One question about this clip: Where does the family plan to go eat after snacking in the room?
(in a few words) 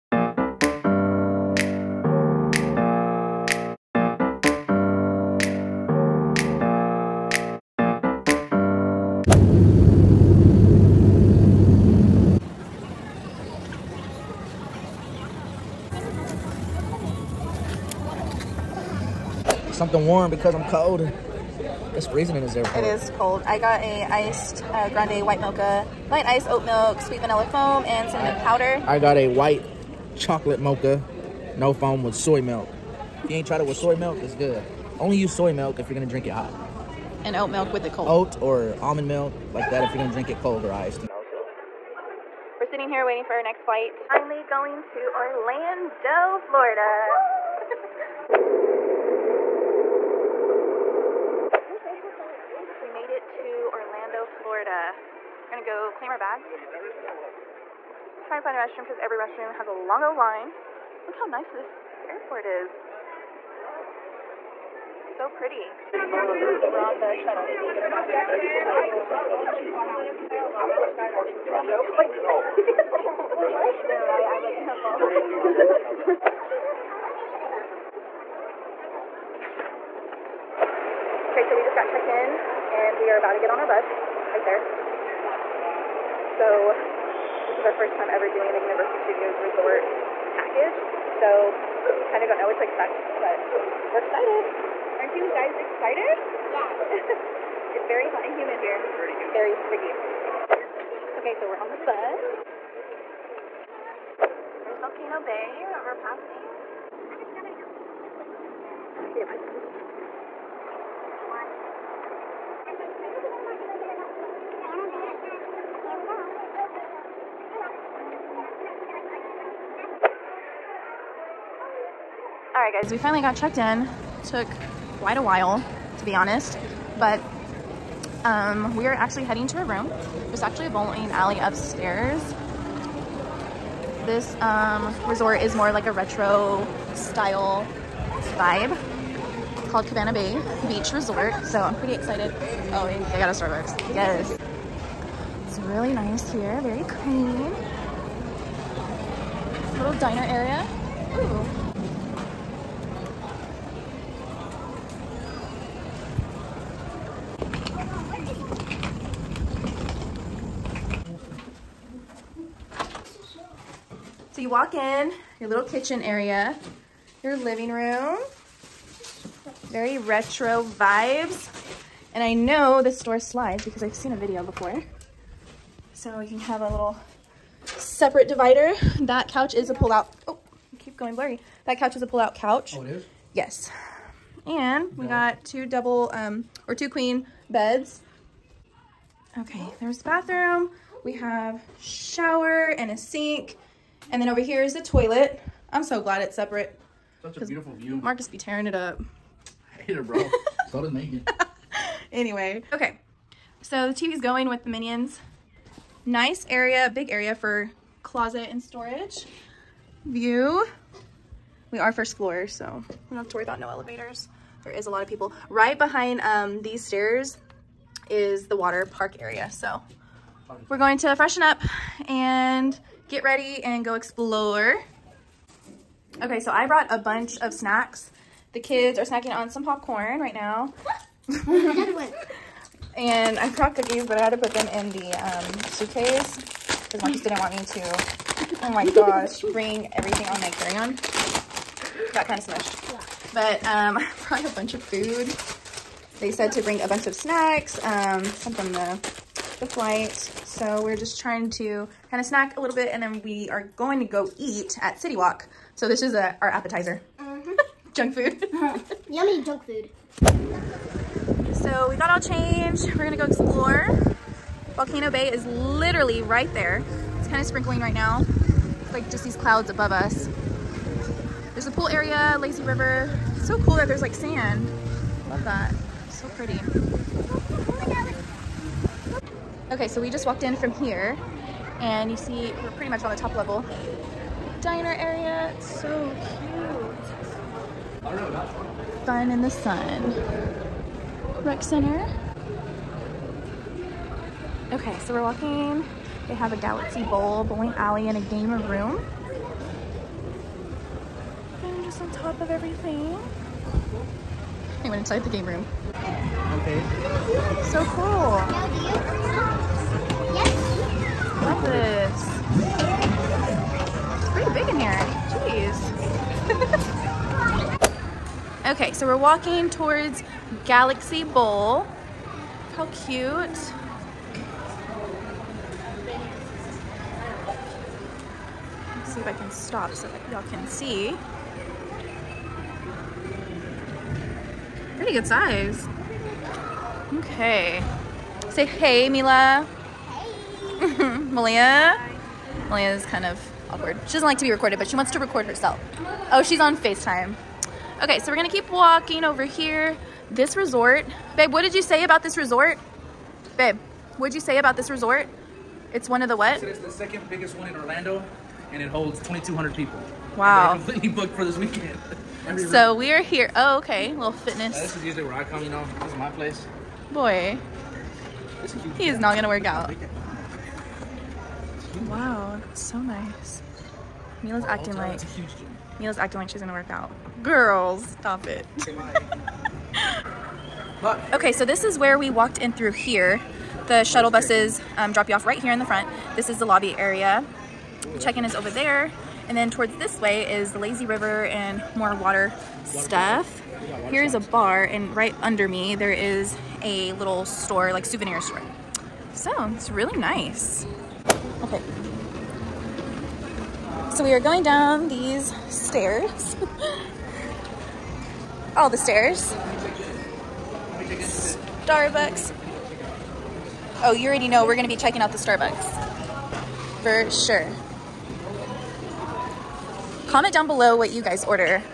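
City Walk.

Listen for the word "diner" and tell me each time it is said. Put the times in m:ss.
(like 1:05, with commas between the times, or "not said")
2:29, 4:44.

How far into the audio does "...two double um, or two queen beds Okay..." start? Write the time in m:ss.
3:05.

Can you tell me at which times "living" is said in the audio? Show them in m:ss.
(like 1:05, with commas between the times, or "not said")
2:47.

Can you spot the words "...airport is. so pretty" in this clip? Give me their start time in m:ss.
1:02.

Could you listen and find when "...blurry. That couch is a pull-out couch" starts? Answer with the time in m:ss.
3:01.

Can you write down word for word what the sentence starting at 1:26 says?
So is our first time ever doing the Universal Studios Resort package.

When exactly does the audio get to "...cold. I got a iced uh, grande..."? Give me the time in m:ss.
0:23.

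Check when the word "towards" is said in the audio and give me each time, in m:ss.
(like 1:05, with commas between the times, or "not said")
5:19, 6:29.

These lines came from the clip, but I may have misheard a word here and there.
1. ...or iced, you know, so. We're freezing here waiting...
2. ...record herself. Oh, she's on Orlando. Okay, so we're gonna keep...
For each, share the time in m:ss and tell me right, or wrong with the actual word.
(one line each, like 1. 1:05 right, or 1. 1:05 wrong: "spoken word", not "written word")
1. 0:40 wrong: "sitting", not "freezing"
2. 5:45 wrong: "FaceTime", not "Orlando".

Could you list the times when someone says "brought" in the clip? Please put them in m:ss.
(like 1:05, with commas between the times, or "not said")
3:46, 3:53, 4:04.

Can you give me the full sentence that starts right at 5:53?
Babe, what'd you say about this resort?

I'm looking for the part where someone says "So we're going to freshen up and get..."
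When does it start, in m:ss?
3:39.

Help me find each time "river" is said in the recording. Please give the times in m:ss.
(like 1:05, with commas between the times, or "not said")
4:32, 6:31.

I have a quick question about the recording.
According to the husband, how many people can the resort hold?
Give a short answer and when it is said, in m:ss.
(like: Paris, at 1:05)
2,200, at 5:59.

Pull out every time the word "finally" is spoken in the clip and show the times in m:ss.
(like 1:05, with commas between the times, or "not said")
0:44, 2:02.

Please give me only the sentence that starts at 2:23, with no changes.
Yes really nice here, very clean.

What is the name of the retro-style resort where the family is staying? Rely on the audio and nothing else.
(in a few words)
Cabana Bay Beach Resort.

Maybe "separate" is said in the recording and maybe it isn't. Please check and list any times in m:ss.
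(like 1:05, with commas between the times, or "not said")
2:57, 3:16.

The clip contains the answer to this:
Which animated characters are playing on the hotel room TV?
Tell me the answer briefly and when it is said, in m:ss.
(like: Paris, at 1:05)
Minions, at 3:24.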